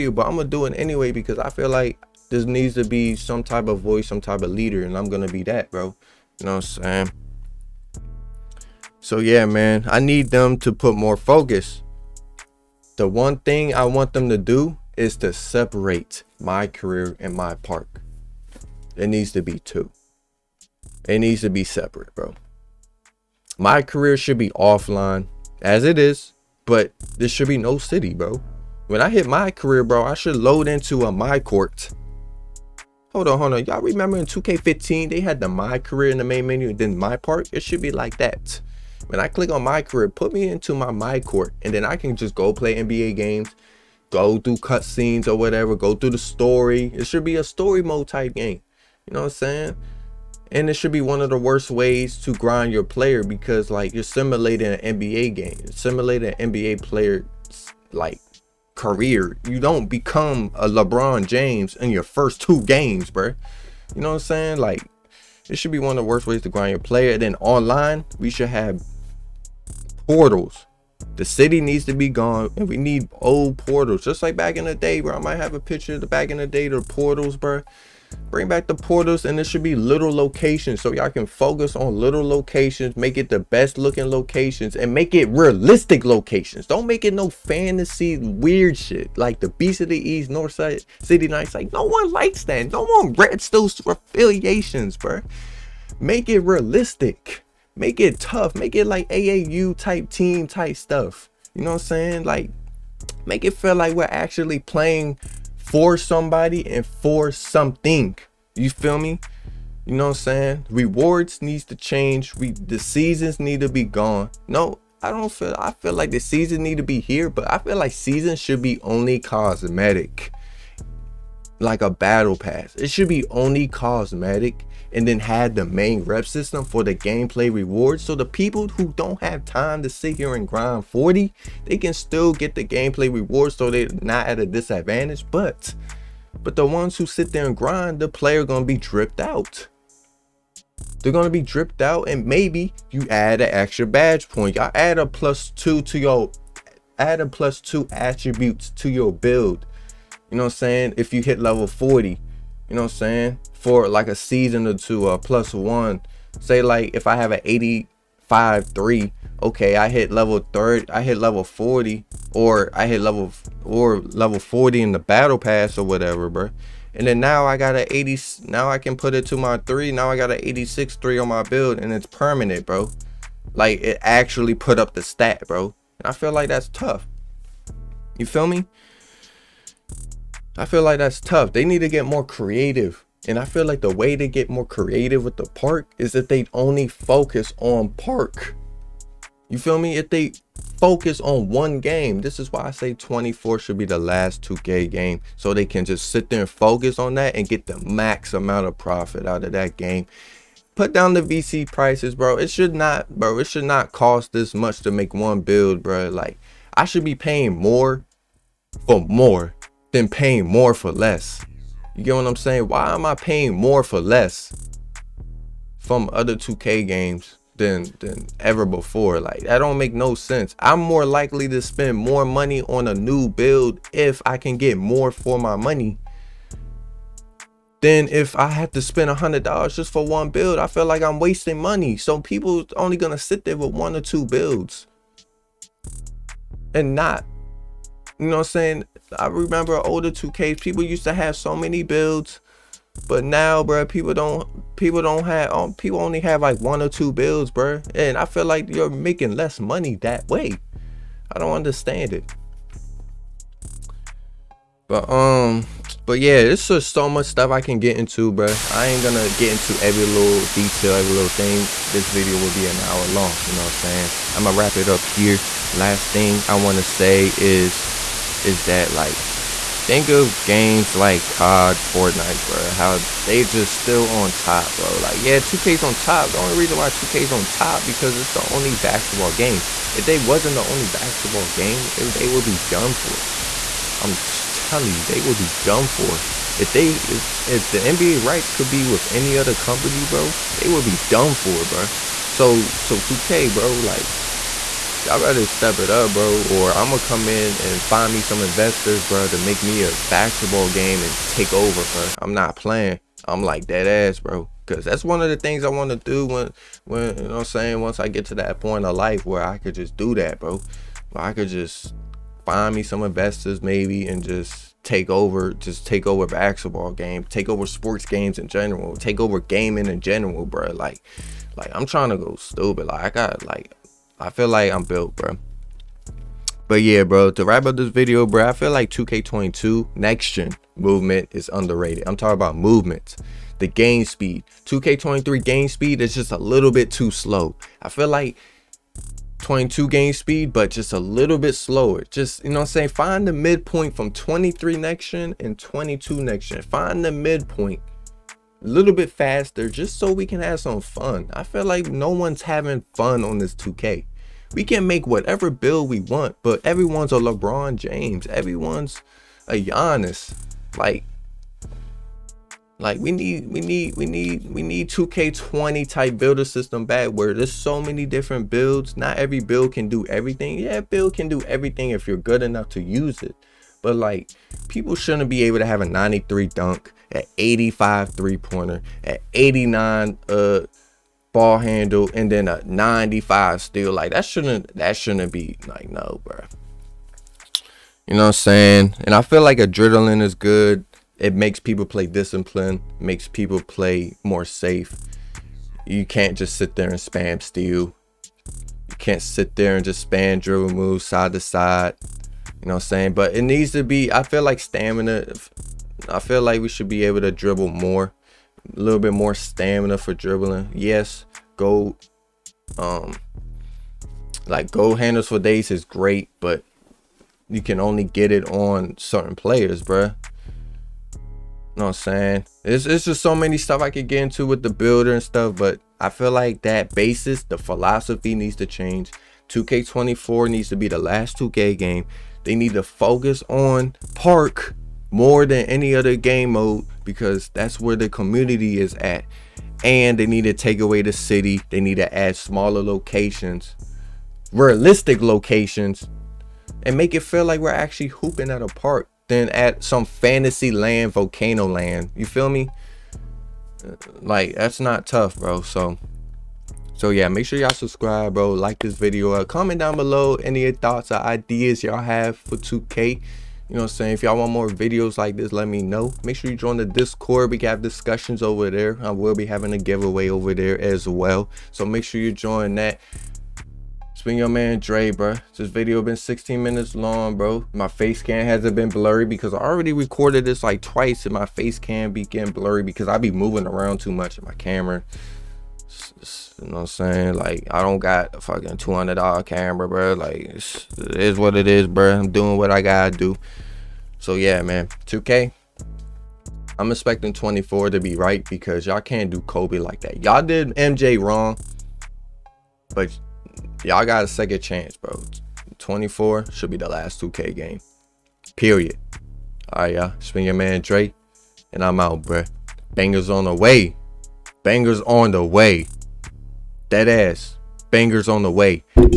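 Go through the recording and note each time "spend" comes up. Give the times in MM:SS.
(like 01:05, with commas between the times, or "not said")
03:41, 03:48.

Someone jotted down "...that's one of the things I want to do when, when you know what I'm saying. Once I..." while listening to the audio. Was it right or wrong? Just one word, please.
right.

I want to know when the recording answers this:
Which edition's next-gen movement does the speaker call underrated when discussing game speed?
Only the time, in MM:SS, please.
05:28.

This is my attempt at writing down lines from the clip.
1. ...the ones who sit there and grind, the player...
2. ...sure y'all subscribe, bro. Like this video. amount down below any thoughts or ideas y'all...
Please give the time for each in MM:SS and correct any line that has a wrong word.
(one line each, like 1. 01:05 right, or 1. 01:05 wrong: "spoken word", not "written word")
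1. 02:16 right
2. 07:37 wrong: "comment", not "amount".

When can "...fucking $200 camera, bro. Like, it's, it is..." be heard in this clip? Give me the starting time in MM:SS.
08:08.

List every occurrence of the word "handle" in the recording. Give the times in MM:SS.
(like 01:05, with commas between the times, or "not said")
06:21, 06:54.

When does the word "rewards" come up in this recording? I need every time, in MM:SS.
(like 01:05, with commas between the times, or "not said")
01:50, 02:07, 02:13.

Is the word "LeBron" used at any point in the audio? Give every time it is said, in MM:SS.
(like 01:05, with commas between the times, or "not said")
01:00, 05:57.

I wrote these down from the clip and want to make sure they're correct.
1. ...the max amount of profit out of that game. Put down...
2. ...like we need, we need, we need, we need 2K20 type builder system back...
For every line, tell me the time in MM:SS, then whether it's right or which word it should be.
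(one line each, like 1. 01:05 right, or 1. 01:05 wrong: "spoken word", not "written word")
1. 03:17 right
2. 06:02 right.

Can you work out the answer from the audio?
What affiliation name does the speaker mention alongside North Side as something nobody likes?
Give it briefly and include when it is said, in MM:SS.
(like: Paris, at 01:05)
Beast of the East, at 01:29.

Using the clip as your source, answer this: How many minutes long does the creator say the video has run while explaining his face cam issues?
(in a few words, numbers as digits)
16.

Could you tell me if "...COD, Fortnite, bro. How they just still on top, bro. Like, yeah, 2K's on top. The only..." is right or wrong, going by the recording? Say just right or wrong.
right.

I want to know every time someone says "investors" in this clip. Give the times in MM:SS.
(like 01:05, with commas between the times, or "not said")
04:58, 05:13.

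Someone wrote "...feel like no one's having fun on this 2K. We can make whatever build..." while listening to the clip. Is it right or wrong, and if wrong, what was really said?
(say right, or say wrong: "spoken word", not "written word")
right.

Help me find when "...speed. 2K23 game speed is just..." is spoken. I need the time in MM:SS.
05:34.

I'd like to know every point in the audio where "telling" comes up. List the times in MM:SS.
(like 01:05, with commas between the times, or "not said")
04:44.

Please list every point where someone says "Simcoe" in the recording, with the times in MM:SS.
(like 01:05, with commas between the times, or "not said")
not said.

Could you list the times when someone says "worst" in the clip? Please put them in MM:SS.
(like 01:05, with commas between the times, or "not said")
00:51, 01:06.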